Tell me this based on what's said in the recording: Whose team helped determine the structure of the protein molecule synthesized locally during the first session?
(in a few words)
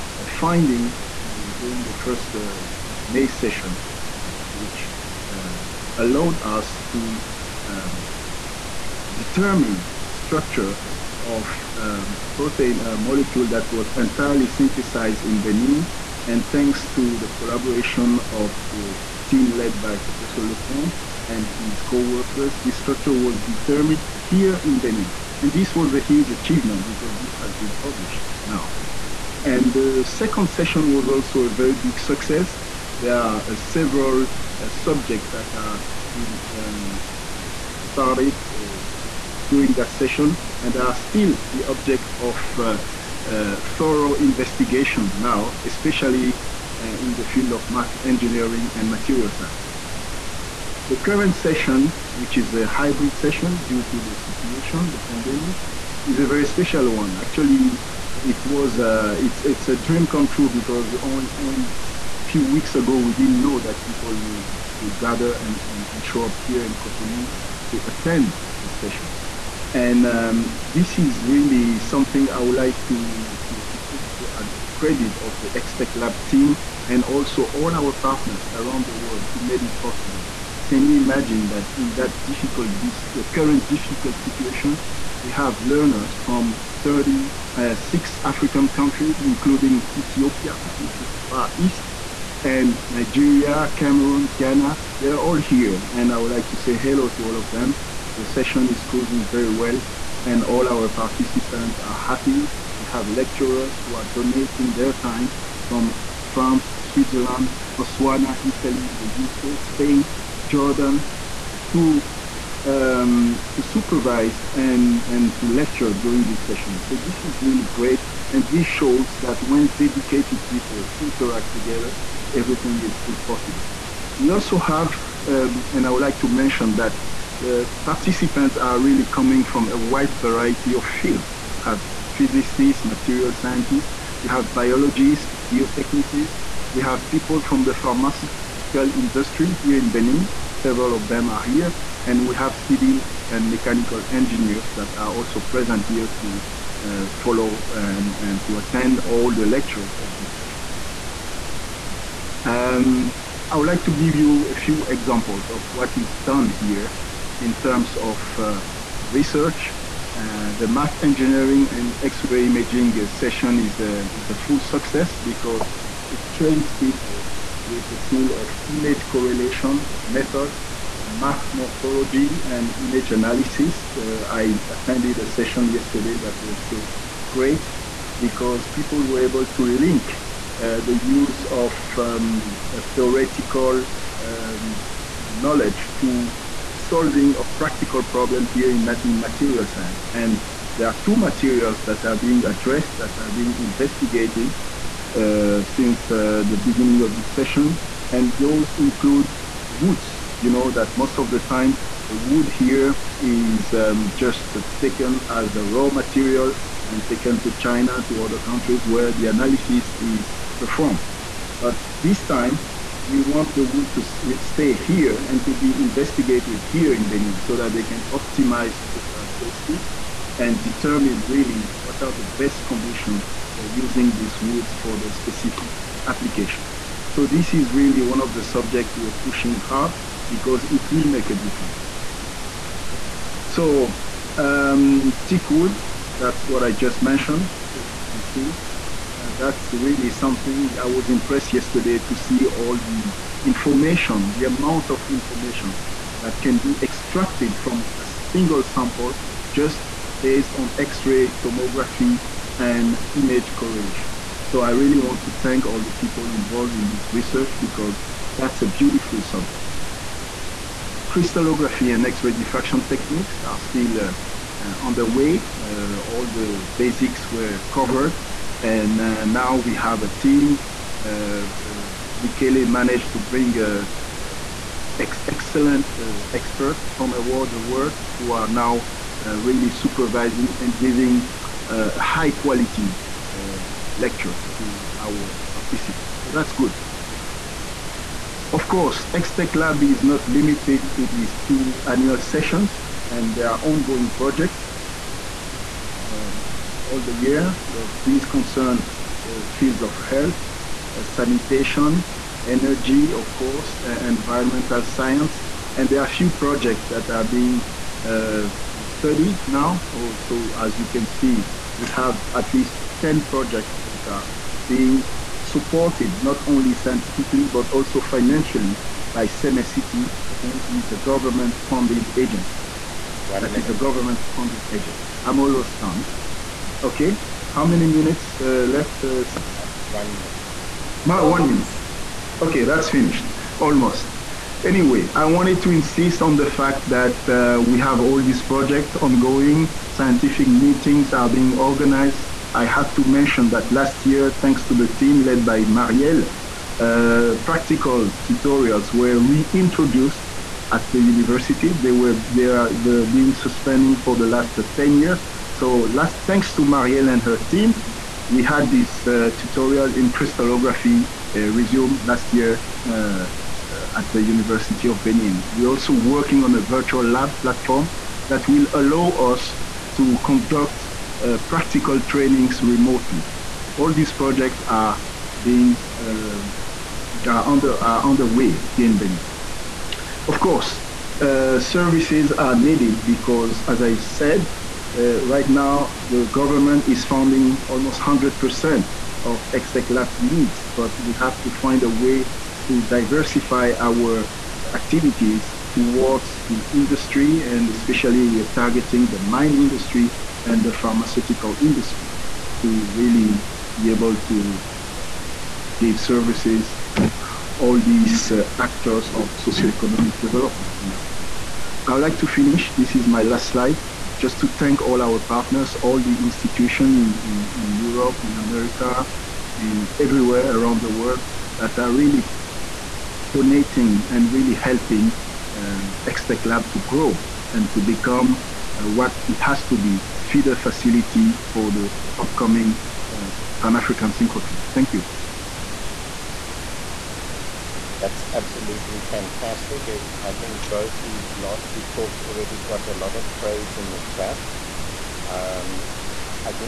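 Lecomte.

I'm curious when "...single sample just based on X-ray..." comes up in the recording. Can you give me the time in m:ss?
4:08.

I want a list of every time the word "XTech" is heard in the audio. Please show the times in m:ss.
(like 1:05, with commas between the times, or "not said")
1:15, 4:49, 6:29, 7:06.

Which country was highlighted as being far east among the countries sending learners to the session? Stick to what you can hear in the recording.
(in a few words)
Ethiopia.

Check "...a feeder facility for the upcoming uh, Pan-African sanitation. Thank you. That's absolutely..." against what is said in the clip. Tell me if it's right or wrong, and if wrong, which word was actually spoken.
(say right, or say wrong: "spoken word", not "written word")
wrong: "synchrotron", not "sanitation".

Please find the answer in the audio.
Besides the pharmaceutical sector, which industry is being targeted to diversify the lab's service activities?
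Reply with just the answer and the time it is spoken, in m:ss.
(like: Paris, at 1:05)
Mine industry, at 6:39.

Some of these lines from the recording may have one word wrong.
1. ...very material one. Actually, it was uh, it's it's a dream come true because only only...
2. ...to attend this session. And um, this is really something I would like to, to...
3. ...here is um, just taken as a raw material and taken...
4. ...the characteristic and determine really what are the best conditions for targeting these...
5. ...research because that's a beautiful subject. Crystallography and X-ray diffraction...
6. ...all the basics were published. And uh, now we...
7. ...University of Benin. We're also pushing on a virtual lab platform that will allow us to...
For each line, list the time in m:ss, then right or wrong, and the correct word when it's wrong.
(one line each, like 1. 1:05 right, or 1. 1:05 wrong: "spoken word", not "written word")
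1. 0:56 wrong: "special", not "material"
2. 1:07 right
3. 3:22 right
4. 3:38 wrong: "using", not "targeting"
5. 4:17 right
6. 4:25 wrong: "covered", not "published"
7. 6:04 wrong: "working", not "pushing".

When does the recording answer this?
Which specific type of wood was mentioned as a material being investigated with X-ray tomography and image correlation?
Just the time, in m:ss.
3:55.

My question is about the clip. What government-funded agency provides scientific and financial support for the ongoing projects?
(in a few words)
Sèmè City.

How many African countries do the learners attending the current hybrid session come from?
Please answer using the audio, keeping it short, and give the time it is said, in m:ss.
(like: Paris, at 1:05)
36, at 1:26.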